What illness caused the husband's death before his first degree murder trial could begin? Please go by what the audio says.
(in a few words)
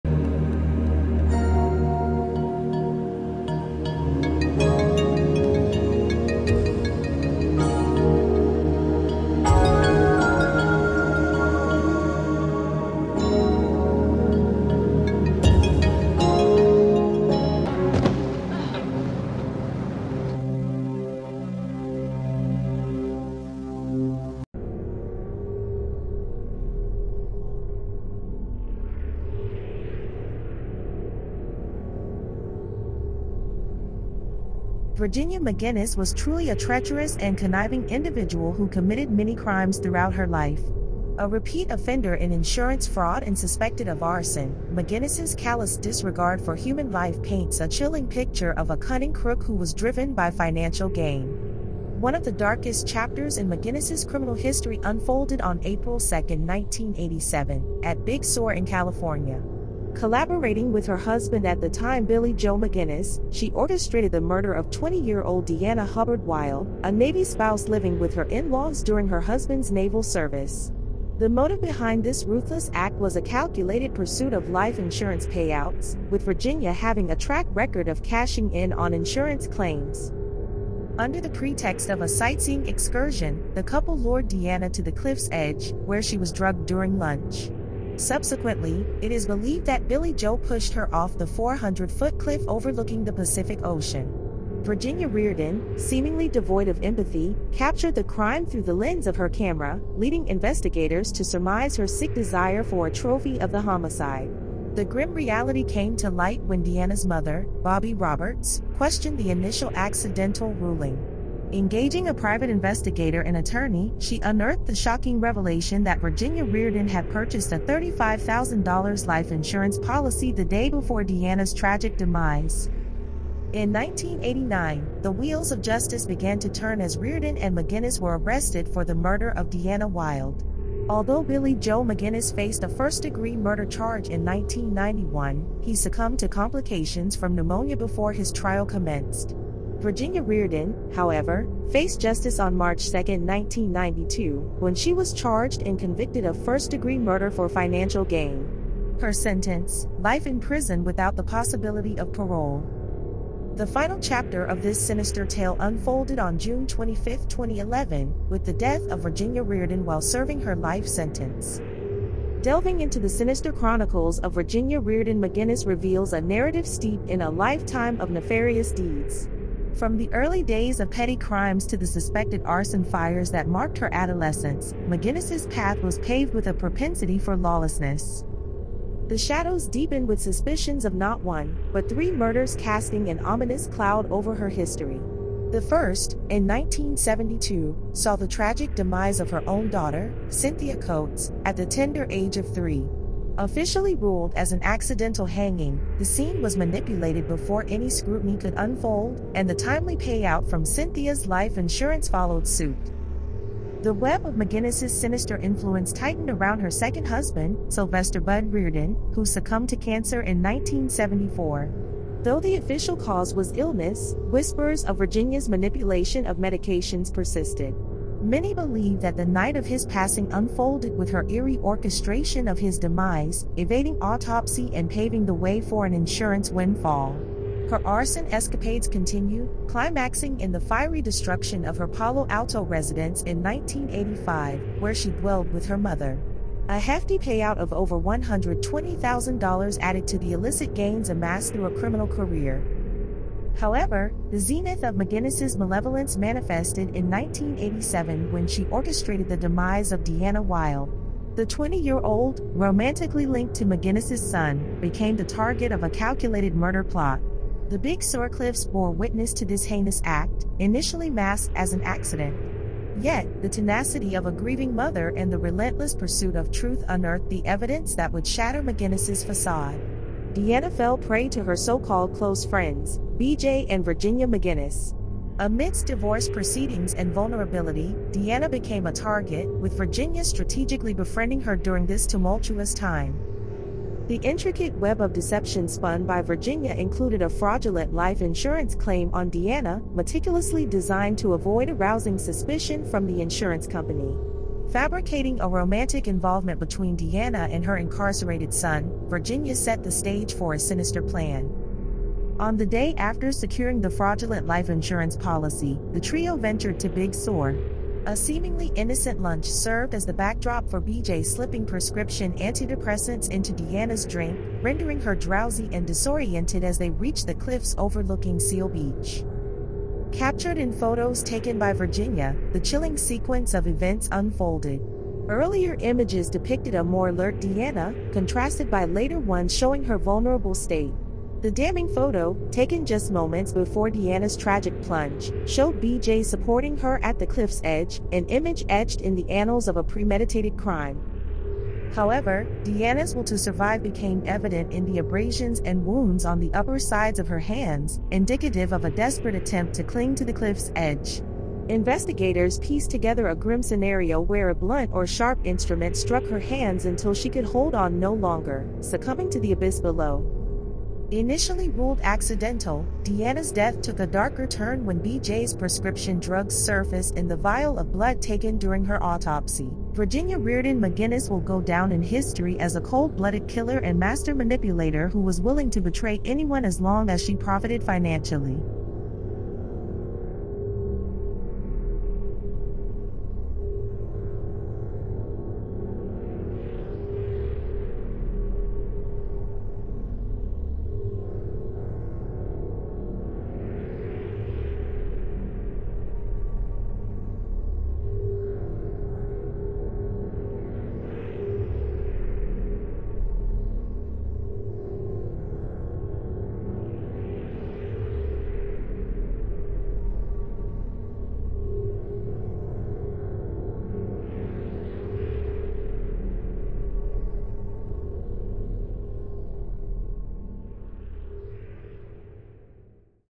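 pneumonia.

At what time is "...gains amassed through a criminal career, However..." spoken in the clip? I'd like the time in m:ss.
4:00.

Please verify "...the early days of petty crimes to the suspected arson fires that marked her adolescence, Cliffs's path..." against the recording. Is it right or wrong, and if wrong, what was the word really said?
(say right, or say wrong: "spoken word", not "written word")
wrong: "McGinnis", not "Cliffs".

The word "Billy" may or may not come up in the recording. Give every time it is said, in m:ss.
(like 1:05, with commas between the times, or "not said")
1:02, 1:29, 2:11.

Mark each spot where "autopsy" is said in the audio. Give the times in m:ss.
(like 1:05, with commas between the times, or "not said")
3:43, 6:09.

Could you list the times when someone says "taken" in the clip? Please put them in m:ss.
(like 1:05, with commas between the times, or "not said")
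5:21, 5:32, 6:08.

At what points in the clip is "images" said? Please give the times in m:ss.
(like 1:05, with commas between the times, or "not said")
5:25, 5:38.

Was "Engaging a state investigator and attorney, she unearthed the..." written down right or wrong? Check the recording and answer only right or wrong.
wrong.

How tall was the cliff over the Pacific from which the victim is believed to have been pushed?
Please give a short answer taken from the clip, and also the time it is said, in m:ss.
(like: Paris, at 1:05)
400-foot, at 1:31.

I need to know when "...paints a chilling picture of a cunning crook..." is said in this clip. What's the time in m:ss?
0:47.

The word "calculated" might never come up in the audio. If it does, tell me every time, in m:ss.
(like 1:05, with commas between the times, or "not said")
1:13, 4:15.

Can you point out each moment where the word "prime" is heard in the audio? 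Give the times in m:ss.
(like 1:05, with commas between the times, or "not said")
not said.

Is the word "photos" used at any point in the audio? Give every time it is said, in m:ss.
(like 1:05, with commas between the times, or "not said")
5:20, 5:31.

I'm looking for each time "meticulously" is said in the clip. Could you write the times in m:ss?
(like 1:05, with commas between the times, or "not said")
4:49.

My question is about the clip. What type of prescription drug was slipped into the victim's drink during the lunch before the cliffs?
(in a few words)
antidepressants.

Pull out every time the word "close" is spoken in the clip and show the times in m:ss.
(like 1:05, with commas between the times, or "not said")
4:32.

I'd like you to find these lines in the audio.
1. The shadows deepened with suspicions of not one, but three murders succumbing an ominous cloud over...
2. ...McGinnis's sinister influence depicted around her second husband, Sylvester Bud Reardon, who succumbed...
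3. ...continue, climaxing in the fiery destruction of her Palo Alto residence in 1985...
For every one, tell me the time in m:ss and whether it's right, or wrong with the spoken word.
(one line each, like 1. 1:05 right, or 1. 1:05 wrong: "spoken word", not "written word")
1. 2:59 wrong: "casting", not "succumbing"
2. 3:24 wrong: "tightened", not "depicted"
3. 3:48 right.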